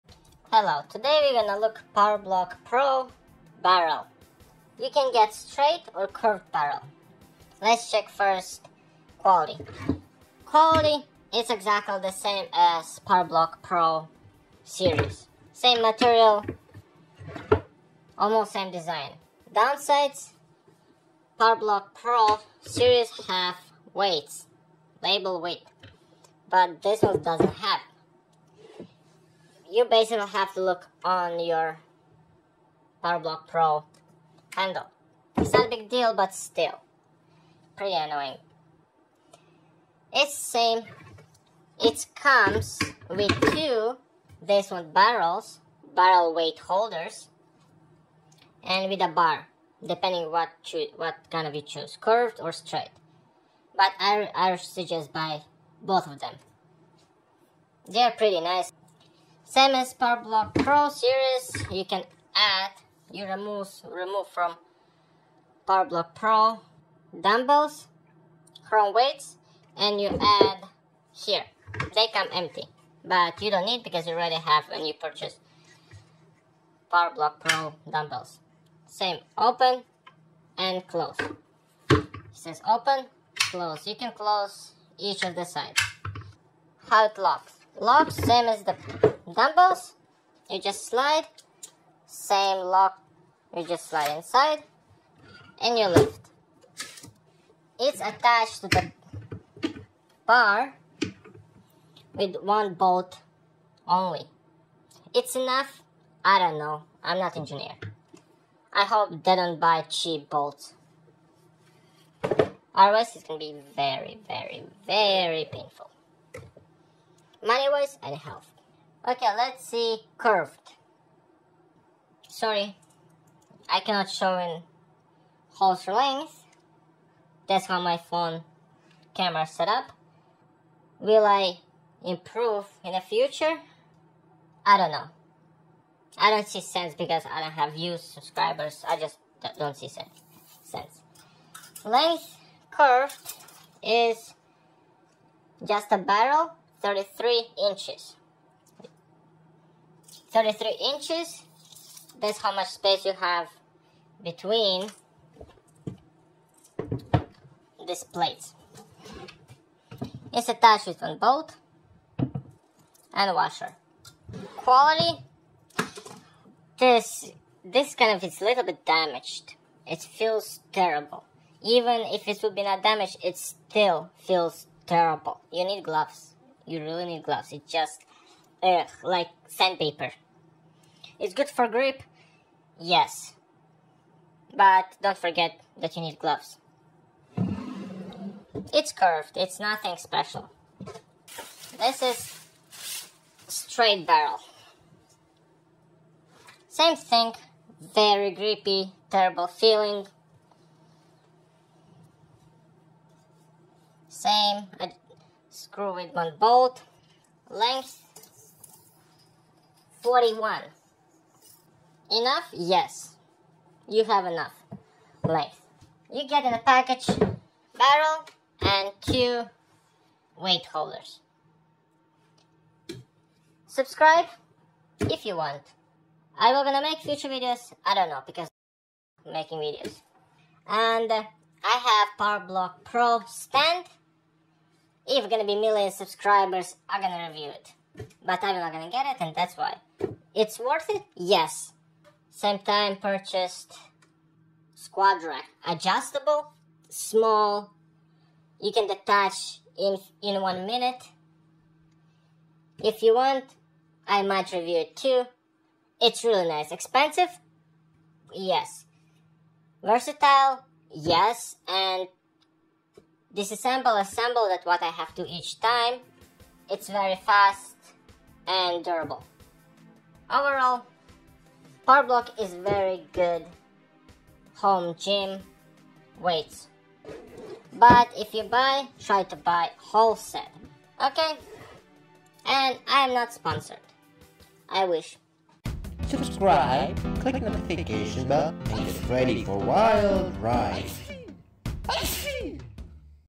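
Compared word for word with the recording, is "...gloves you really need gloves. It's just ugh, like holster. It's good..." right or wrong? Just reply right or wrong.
wrong.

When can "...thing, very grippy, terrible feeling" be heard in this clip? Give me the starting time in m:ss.
3:16.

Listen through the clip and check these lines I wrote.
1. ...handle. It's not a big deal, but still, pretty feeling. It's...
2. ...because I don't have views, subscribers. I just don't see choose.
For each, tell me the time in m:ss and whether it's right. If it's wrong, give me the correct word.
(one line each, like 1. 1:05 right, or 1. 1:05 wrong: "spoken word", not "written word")
1. 0:34 wrong: "annoying", not "feeling"
2. 2:16 wrong: "sense", not "choose".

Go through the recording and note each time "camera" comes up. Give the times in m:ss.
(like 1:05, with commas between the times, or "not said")
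2:09.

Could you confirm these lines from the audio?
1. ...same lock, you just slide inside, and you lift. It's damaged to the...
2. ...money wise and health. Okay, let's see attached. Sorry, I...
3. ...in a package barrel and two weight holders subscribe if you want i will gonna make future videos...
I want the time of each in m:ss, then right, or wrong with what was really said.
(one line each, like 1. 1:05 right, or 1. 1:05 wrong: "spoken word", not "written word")
1. 1:32 wrong: "attached", not "damaged"
2. 1:57 wrong: "curved", not "attached"
3. 3:36 right.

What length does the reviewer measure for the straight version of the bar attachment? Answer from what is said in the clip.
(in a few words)
41.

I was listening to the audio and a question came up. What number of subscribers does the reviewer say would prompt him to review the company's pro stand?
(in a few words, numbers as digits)
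1 million.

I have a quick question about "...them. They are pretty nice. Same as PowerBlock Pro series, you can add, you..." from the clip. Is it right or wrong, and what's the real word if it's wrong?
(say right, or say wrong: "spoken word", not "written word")
right.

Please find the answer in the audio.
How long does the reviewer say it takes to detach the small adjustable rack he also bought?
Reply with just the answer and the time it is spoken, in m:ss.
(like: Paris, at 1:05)
1 minute, at 4:10.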